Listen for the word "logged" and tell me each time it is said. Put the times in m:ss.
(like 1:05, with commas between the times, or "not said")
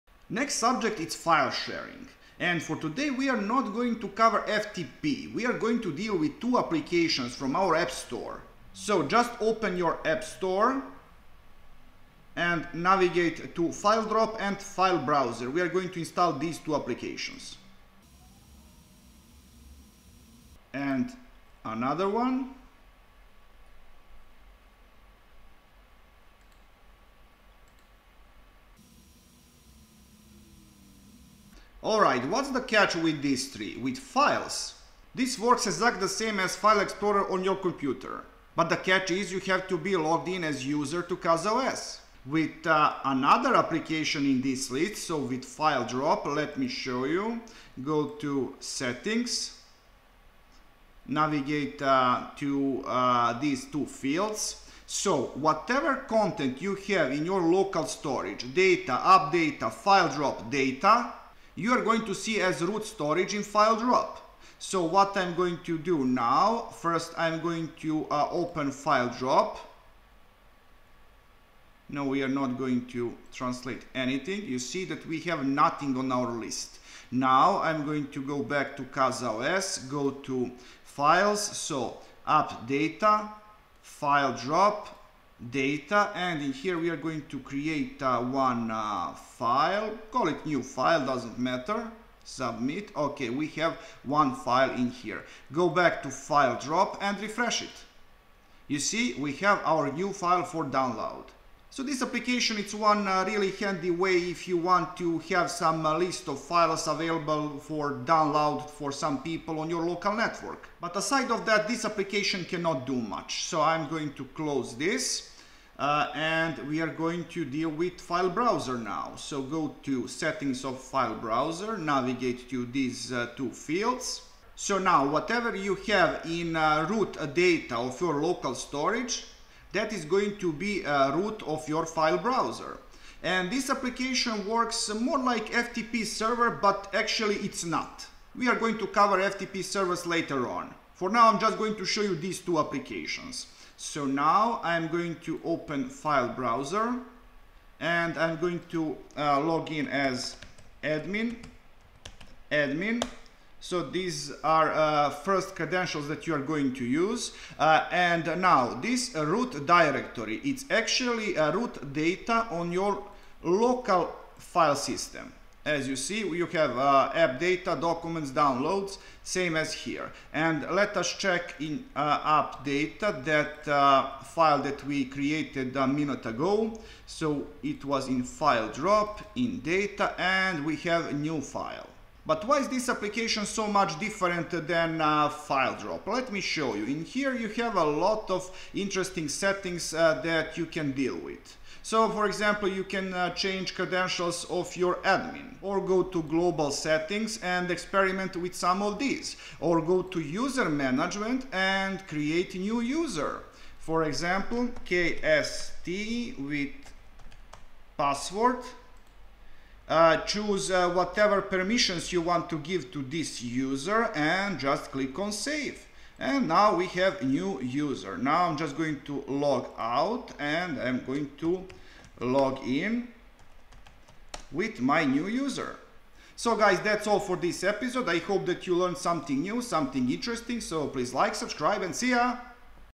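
0:39.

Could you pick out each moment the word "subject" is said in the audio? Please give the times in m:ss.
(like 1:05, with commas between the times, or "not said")
0:00.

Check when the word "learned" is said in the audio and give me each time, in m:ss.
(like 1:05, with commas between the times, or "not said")
3:48.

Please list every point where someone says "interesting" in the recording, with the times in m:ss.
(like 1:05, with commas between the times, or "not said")
3:08, 3:50.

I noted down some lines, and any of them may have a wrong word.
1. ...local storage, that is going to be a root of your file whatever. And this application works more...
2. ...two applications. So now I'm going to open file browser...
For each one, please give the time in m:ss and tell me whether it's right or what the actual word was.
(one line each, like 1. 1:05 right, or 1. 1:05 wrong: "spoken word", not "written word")
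1. 2:08 wrong: "browser", not "whatever"
2. 2:22 right.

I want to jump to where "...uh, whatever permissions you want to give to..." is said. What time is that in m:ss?
3:30.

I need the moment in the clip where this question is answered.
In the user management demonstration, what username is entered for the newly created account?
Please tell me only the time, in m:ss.
3:24.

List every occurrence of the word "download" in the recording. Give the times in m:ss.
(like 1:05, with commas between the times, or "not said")
1:40, 1:48, 2:48.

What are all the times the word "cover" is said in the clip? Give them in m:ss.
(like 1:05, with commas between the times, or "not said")
0:04, 2:18.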